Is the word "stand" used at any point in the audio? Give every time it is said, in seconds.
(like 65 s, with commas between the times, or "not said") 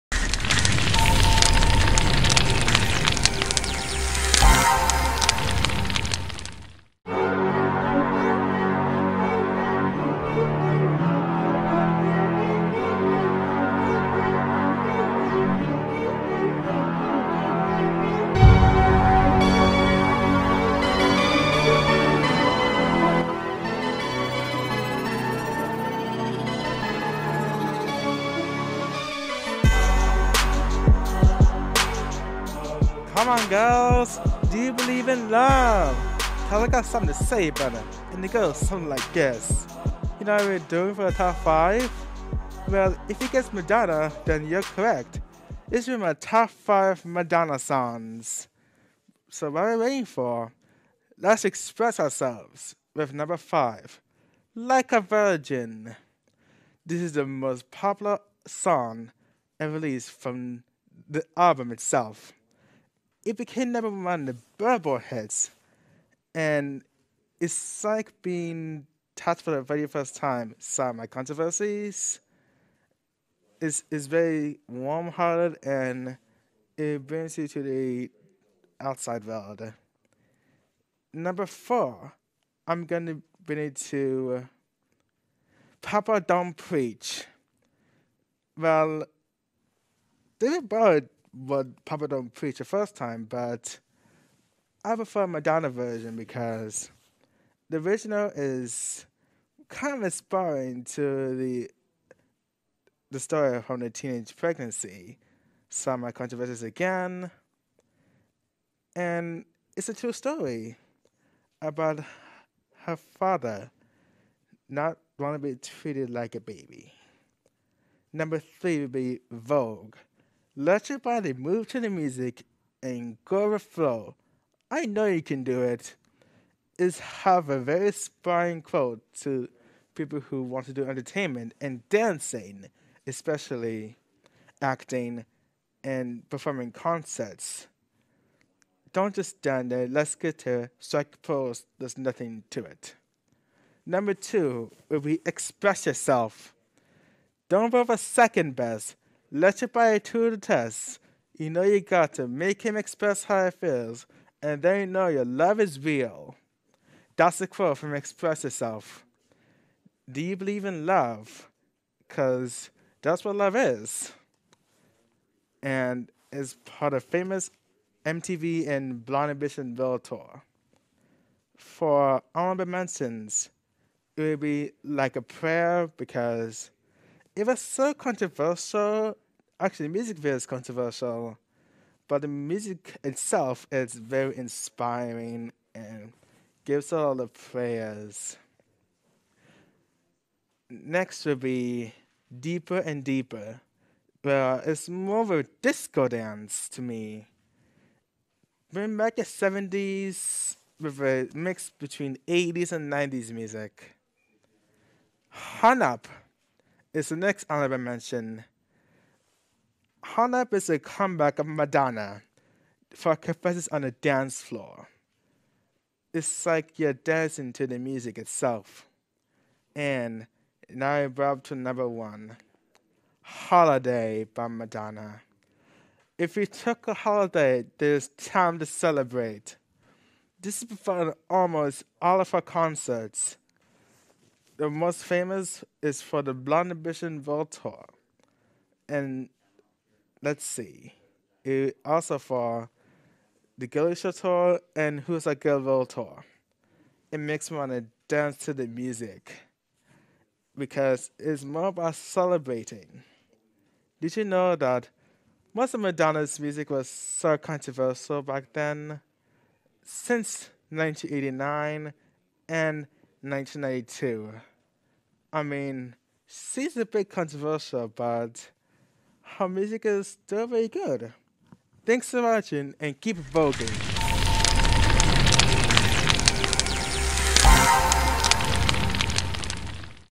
139 s.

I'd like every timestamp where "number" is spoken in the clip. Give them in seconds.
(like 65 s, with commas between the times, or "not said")
53 s, 63 s, 81 s, 118 s, 143 s, 221 s.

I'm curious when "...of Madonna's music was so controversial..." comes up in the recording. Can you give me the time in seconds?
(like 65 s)
255 s.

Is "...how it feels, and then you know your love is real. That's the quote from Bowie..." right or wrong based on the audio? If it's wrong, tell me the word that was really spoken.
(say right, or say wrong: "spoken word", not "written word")
wrong: "Express", not "Bowie".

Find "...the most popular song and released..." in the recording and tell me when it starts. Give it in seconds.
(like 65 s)
57 s.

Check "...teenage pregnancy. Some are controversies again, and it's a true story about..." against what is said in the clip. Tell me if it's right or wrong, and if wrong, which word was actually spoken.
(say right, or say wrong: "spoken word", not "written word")
right.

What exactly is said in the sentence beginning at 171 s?
For honorable mentions, it would be like a prayer because it was so controversial.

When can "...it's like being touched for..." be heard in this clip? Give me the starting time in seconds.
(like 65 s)
67 s.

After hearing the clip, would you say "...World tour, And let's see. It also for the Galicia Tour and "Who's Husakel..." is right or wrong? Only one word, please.
right.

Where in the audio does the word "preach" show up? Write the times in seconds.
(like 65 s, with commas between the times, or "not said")
86 s, 92 s.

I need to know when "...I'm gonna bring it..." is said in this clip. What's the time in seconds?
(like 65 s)
82 s.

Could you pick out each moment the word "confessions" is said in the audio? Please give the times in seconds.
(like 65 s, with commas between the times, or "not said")
213 s.